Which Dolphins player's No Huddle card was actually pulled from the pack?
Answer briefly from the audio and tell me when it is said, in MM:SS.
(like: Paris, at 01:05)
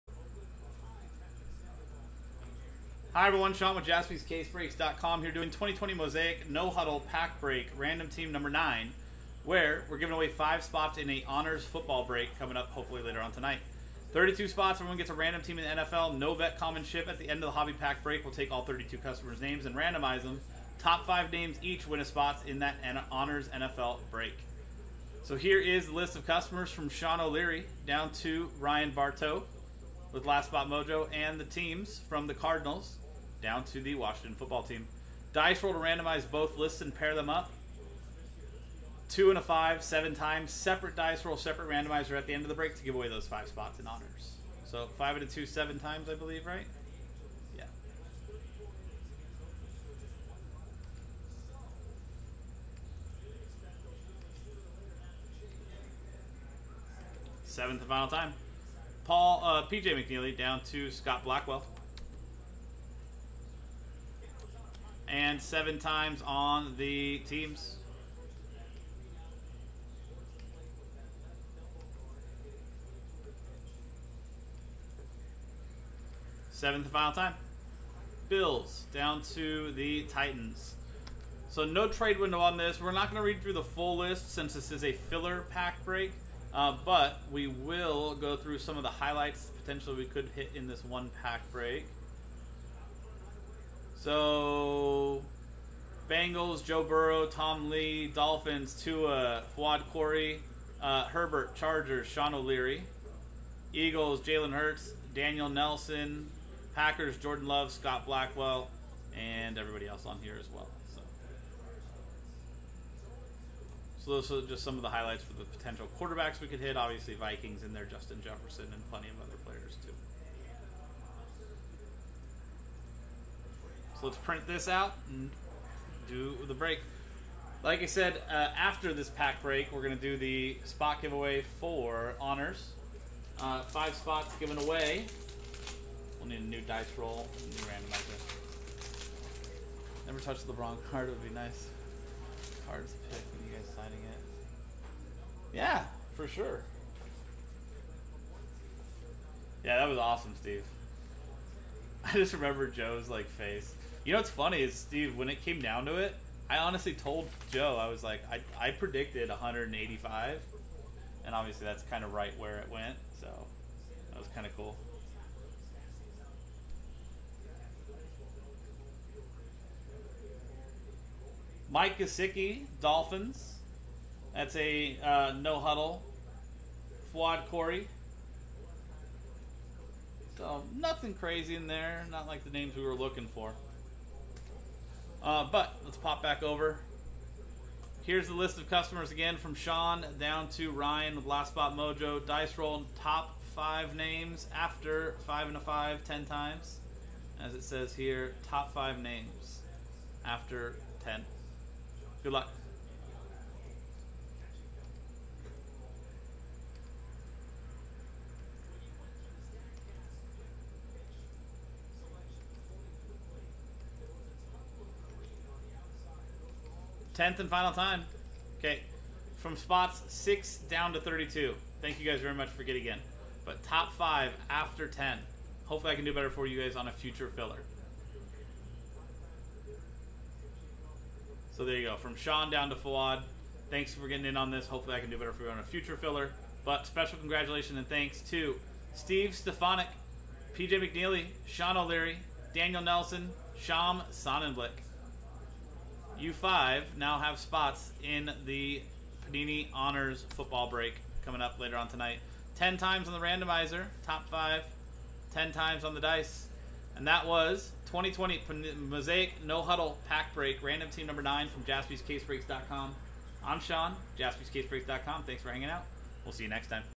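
Mike Gesicki, at 02:51.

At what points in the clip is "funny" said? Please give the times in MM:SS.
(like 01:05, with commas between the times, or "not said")
02:34.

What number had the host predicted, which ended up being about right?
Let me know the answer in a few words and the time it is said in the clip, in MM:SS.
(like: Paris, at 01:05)
185, at 02:39.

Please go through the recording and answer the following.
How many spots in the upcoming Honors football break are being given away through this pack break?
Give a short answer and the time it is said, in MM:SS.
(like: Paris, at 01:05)
5, at 00:10.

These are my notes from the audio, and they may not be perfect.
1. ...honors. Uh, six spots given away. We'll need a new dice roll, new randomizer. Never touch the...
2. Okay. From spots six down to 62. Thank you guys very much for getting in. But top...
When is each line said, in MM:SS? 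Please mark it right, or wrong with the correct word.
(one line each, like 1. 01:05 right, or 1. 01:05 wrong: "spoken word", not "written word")
1. 02:12 wrong: "five", not "six"
2. 03:38 wrong: "32", not "62".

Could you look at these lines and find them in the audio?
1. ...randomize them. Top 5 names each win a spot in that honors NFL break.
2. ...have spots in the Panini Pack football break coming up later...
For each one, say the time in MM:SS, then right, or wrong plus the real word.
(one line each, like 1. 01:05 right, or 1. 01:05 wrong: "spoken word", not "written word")
1. 00:19 right
2. 04:07 wrong: "Honors", not "Pack".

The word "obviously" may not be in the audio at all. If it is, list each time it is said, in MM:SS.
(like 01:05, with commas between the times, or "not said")
01:56, 02:41.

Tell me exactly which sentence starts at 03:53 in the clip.
Thanks for getting in on this.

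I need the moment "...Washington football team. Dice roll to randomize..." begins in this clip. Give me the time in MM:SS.
00:33.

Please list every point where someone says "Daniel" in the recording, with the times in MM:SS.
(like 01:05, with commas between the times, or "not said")
01:45, 04:02.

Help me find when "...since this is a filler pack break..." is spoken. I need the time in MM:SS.
01:24.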